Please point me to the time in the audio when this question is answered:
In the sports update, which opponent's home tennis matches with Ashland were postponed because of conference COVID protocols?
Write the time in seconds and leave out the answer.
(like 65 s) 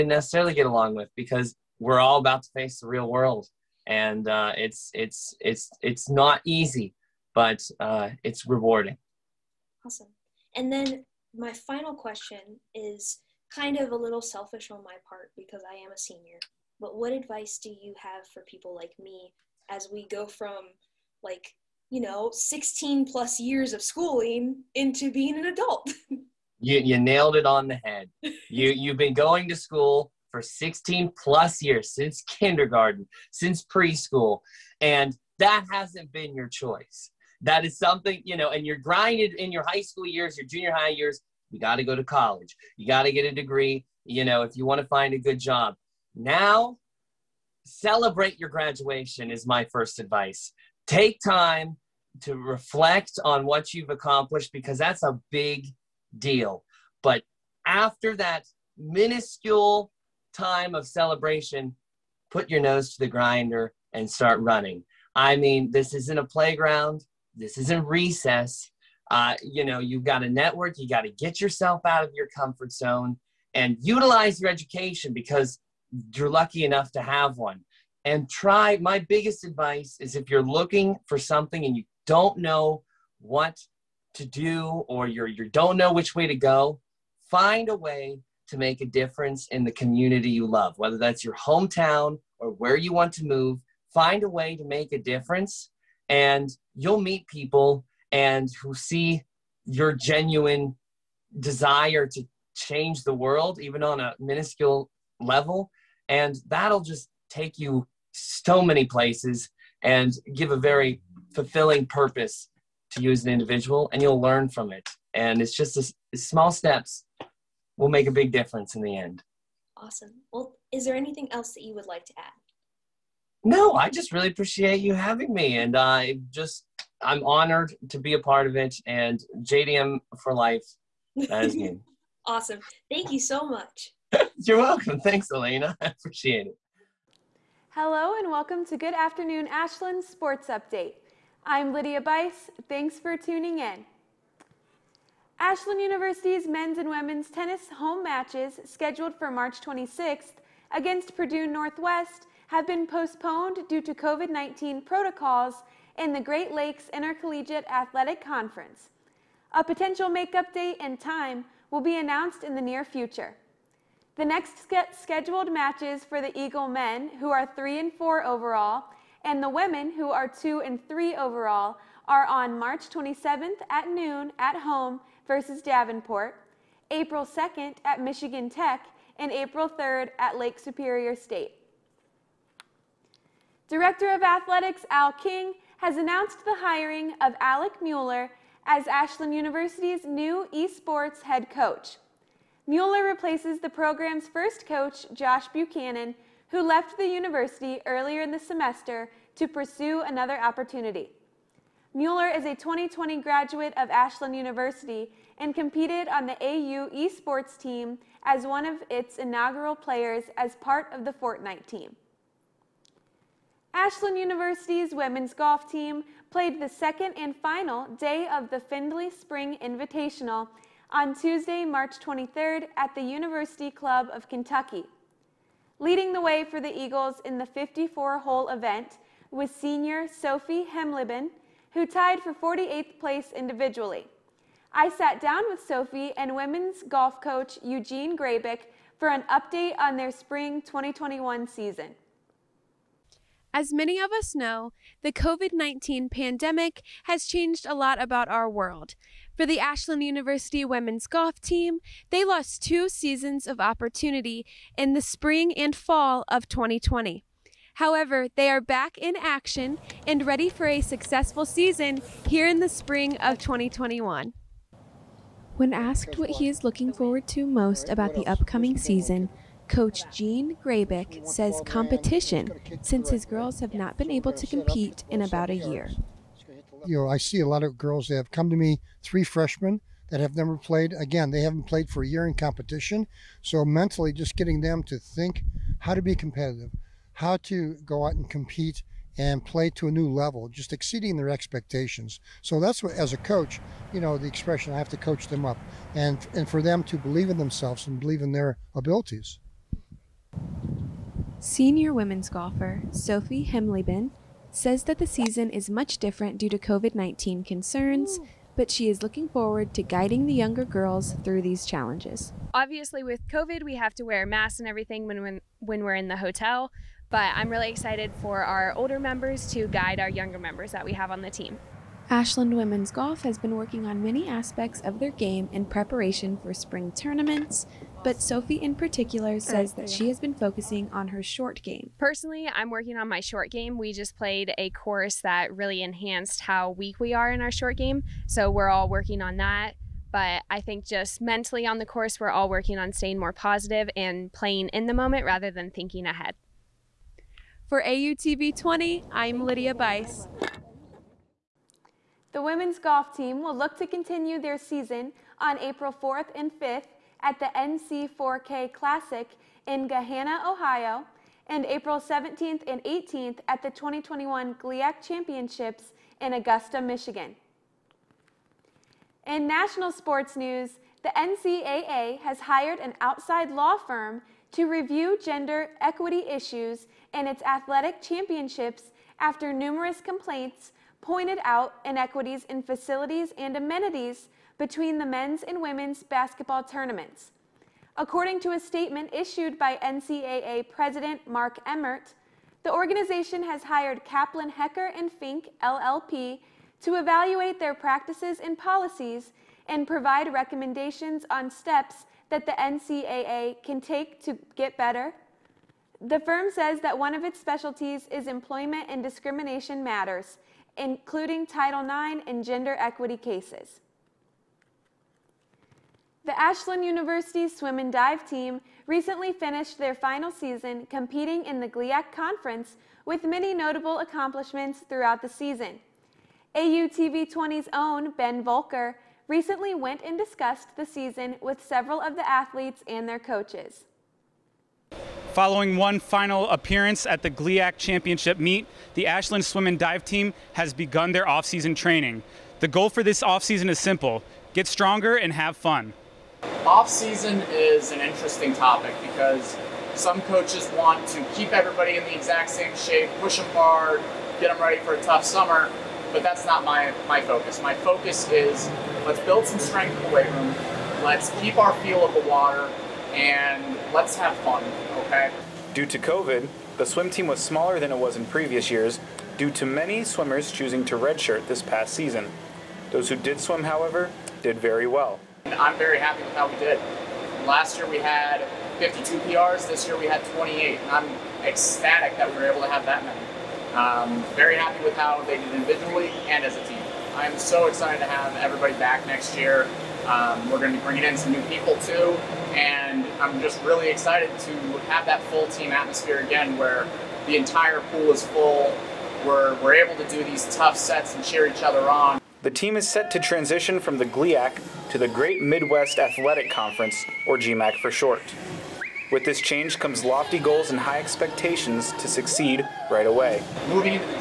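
151 s.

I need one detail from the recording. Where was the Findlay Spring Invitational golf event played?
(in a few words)
University Club of Kentucky.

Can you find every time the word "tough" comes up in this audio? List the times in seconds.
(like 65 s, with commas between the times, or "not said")
455 s, 500 s.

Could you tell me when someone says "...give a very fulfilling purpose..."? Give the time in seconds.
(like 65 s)
110 s.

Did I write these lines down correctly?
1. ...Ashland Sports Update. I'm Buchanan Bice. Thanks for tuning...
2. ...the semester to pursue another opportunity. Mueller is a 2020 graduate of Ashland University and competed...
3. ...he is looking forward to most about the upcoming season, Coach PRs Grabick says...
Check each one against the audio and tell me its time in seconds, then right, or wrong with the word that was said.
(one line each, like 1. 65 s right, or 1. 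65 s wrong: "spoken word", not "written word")
1. 139 s wrong: "Lydia", not "Buchanan"
2. 198 s right
3. 266 s wrong: "Gene", not "PRs".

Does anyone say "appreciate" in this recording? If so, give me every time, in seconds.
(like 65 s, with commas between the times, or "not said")
124 s, 135 s.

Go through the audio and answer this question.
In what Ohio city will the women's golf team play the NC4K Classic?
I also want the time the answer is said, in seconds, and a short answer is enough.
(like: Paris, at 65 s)
Gahanna, at 359 s.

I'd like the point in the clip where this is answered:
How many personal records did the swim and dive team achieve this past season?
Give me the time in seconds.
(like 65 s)
480 s.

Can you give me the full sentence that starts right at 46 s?
Now, celebrate your graduation, is my first advice.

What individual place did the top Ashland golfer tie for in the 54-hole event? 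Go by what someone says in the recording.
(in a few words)
48th.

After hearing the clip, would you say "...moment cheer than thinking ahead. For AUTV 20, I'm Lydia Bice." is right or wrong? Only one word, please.
wrong.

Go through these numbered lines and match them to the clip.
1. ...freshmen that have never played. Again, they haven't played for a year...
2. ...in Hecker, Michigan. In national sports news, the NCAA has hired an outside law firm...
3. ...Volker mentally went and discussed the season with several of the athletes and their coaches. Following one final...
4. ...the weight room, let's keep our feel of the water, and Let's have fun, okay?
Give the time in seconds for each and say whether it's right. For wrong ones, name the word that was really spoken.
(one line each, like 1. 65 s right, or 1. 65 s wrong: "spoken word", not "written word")
1. 279 s right
2. 366 s wrong: "Augusta", not "Hecker"
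3. 428 s wrong: "recently", not "mentally"
4. 460 s right.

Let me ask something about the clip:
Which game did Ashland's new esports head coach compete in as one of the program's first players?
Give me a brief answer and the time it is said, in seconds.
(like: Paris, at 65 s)
Fortnite, at 211 s.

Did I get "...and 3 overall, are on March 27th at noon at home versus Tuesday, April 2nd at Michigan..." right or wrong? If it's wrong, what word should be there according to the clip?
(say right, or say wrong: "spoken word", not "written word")
wrong: "Davenport", not "Tuesday".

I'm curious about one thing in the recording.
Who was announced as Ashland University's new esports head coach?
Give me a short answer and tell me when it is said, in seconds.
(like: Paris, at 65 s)
Alec Mueller, at 187 s.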